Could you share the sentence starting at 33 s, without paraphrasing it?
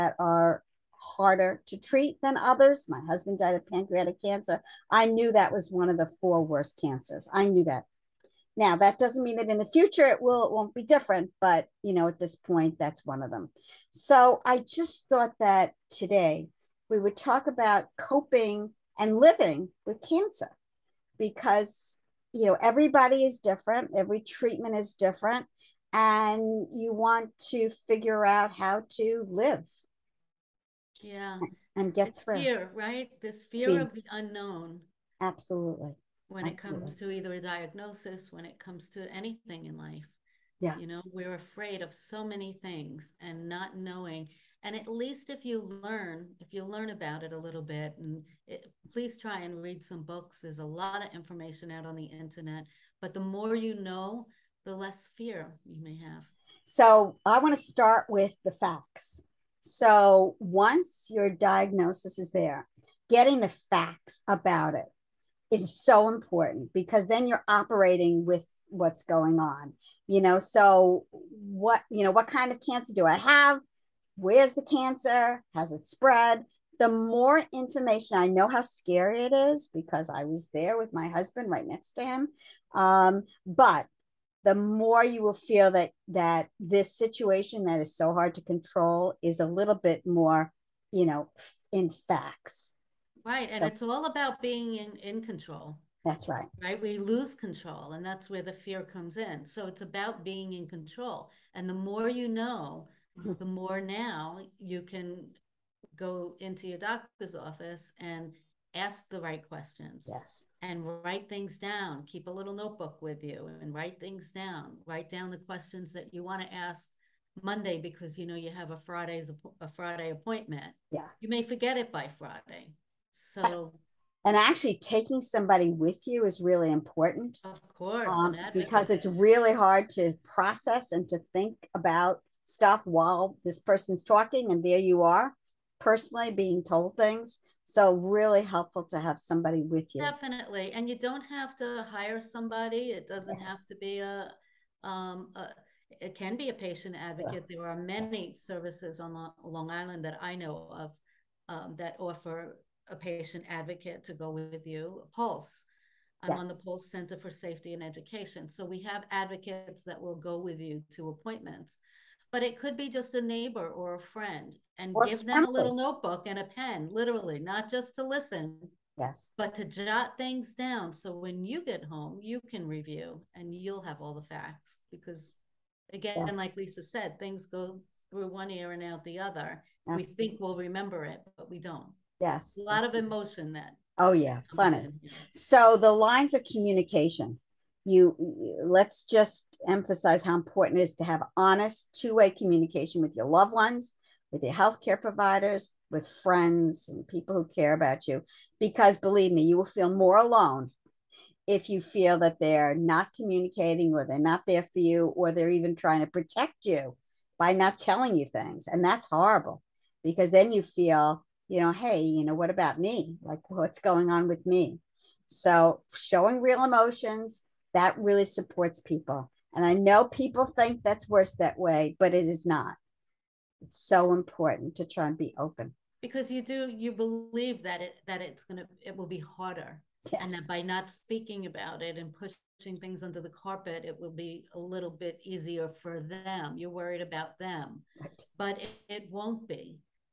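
This fear, fear, of the unknown.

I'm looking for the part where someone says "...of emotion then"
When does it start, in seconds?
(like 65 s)
182 s.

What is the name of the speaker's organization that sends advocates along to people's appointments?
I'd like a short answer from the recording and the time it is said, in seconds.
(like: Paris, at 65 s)
Pulse Center for Safety and Education, at 156 s.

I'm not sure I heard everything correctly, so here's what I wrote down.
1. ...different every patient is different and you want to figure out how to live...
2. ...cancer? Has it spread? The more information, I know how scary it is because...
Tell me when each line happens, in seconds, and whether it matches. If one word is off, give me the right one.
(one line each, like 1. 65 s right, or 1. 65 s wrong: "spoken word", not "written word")
1. 23 s wrong: "treatment", not "patient"
2. 74 s right.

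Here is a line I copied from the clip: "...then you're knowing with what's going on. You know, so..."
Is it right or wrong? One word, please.
wrong.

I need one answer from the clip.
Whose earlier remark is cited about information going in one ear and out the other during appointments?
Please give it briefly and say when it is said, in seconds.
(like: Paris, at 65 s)
Lisa, at 176 s.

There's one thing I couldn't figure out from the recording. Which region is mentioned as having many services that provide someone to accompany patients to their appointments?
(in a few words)
Long Island.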